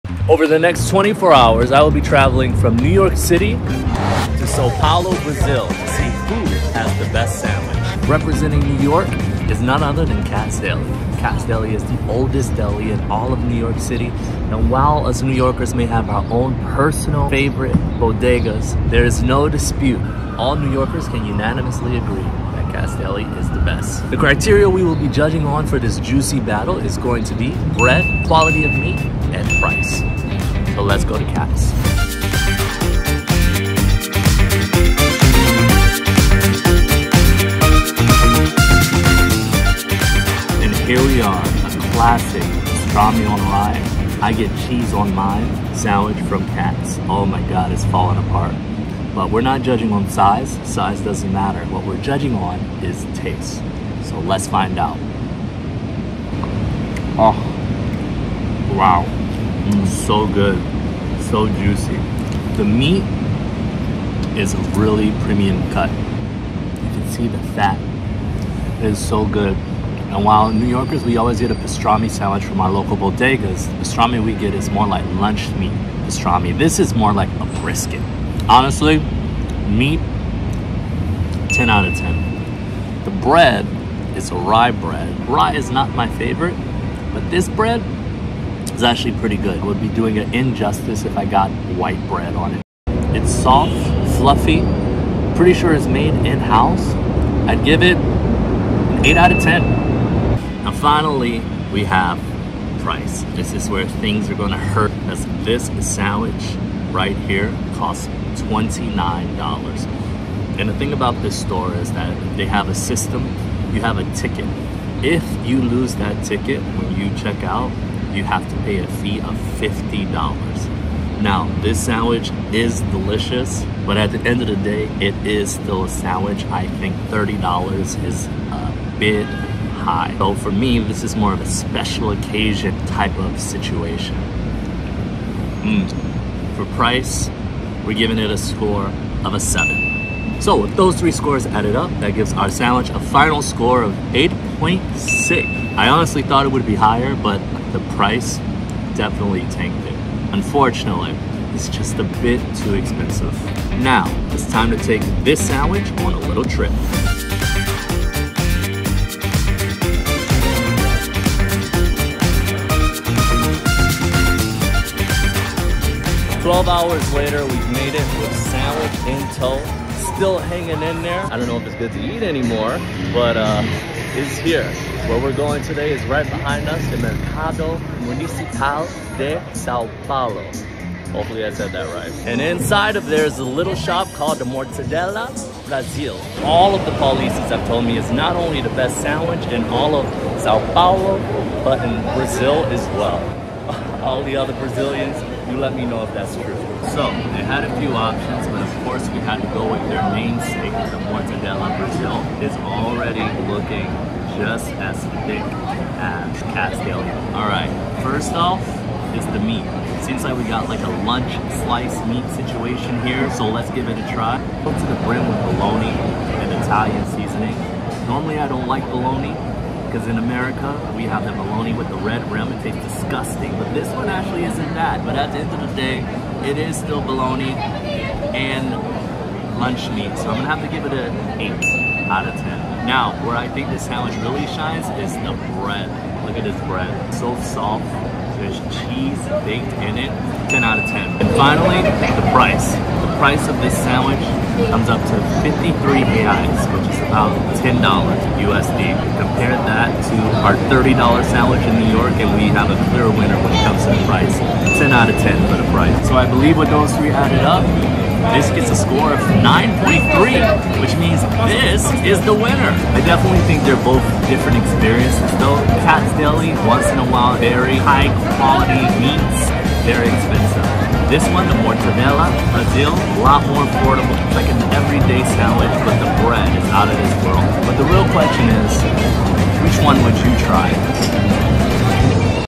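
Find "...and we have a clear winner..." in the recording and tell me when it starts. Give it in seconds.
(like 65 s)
252 s.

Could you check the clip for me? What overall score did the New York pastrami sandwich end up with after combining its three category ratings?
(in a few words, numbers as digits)
8.6.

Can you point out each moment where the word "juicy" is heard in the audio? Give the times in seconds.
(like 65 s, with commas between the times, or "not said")
25 s, 61 s.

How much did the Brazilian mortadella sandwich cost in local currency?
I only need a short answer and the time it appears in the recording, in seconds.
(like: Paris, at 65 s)
53 reais, at 245 s.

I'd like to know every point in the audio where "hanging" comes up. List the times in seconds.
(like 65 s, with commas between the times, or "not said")
170 s.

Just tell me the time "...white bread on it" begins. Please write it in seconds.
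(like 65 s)
91 s.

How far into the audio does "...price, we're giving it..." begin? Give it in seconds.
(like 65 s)
136 s.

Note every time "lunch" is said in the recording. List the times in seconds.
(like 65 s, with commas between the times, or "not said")
75 s, 211 s, 229 s.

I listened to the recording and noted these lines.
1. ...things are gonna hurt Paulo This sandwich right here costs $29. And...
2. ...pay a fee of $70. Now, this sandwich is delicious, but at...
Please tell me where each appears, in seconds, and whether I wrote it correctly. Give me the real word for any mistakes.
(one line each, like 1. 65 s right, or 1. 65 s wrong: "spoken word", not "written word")
1. 103 s wrong: "Because", not "Paulo"
2. 118 s wrong: "50", not "70".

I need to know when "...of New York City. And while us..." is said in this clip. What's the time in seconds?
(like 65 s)
13 s.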